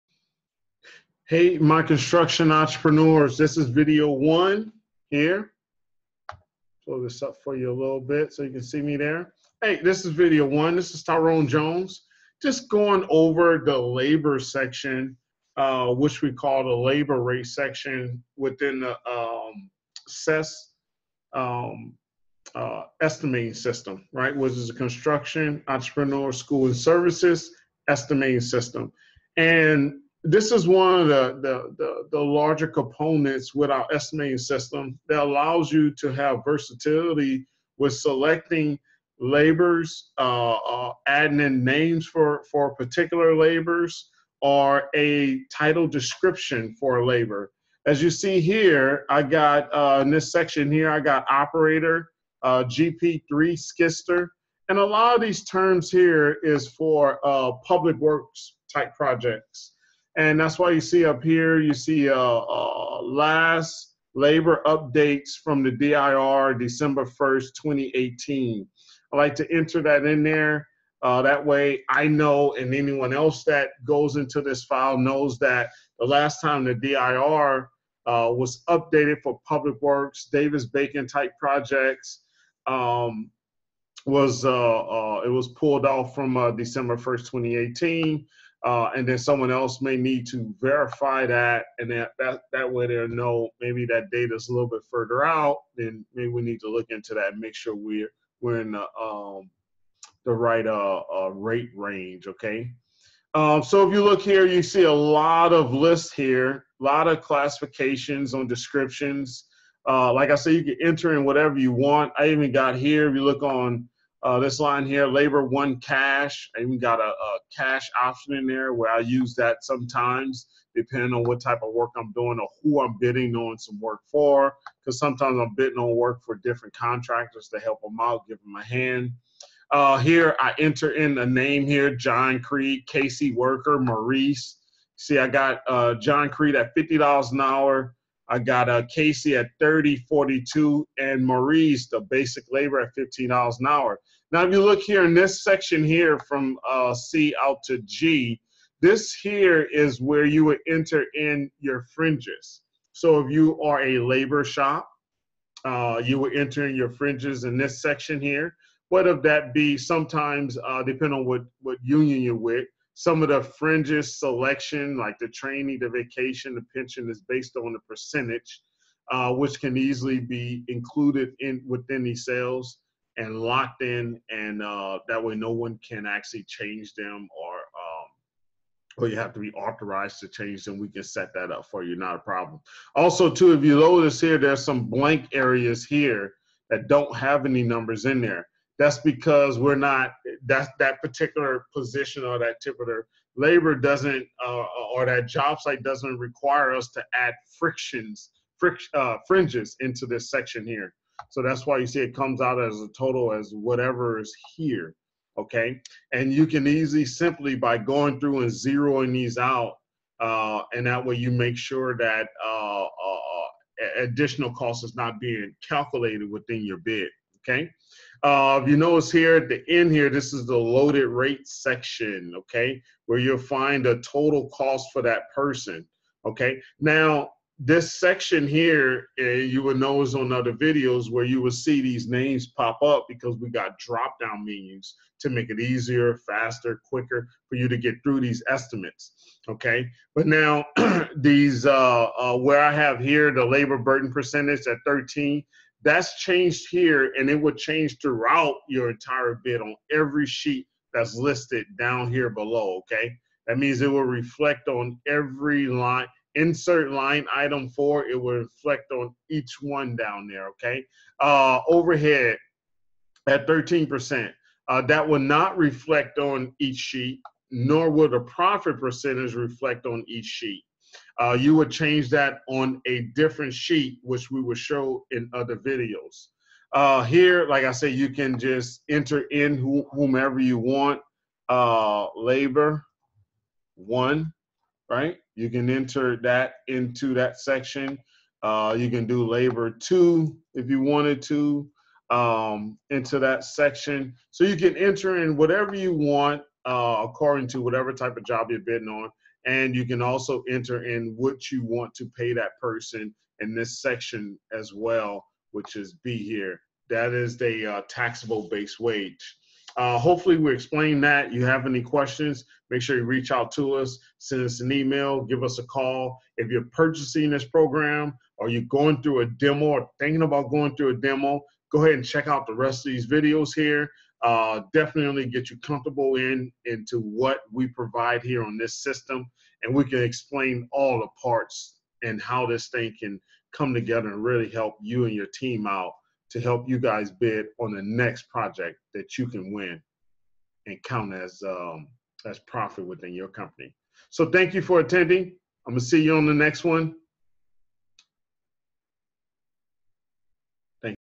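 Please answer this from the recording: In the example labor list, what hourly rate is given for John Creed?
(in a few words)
$50.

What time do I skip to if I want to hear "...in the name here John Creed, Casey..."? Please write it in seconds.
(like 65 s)
130 s.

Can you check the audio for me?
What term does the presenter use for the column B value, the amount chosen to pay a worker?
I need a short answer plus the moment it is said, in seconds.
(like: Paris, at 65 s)
taxable base wage, at 307 s.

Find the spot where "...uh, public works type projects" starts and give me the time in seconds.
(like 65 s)
57 s.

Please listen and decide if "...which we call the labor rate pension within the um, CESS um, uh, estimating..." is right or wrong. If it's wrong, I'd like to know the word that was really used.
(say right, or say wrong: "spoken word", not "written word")
wrong: "section", not "pension".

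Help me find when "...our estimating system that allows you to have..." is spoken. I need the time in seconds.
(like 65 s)
33 s.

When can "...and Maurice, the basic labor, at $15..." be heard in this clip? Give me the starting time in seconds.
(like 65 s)
140 s.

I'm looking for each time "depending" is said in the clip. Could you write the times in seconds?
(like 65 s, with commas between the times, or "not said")
120 s, 160 s.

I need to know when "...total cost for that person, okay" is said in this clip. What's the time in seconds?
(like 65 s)
224 s.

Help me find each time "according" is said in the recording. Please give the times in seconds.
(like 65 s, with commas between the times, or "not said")
297 s.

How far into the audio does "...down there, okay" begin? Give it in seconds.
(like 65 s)
259 s.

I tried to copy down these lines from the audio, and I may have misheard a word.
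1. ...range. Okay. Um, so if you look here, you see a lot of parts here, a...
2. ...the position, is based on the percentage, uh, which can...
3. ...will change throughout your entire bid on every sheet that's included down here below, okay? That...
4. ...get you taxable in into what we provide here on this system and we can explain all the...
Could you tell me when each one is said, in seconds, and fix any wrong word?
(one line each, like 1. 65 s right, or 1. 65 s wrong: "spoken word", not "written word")
1. 101 s wrong: "lists", not "parts"
2. 166 s wrong: "pension", not "position"
3. 247 s wrong: "listed", not "included"
4. 325 s wrong: "comfortable", not "taxable".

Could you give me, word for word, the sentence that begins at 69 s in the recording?
I like to enter that in there.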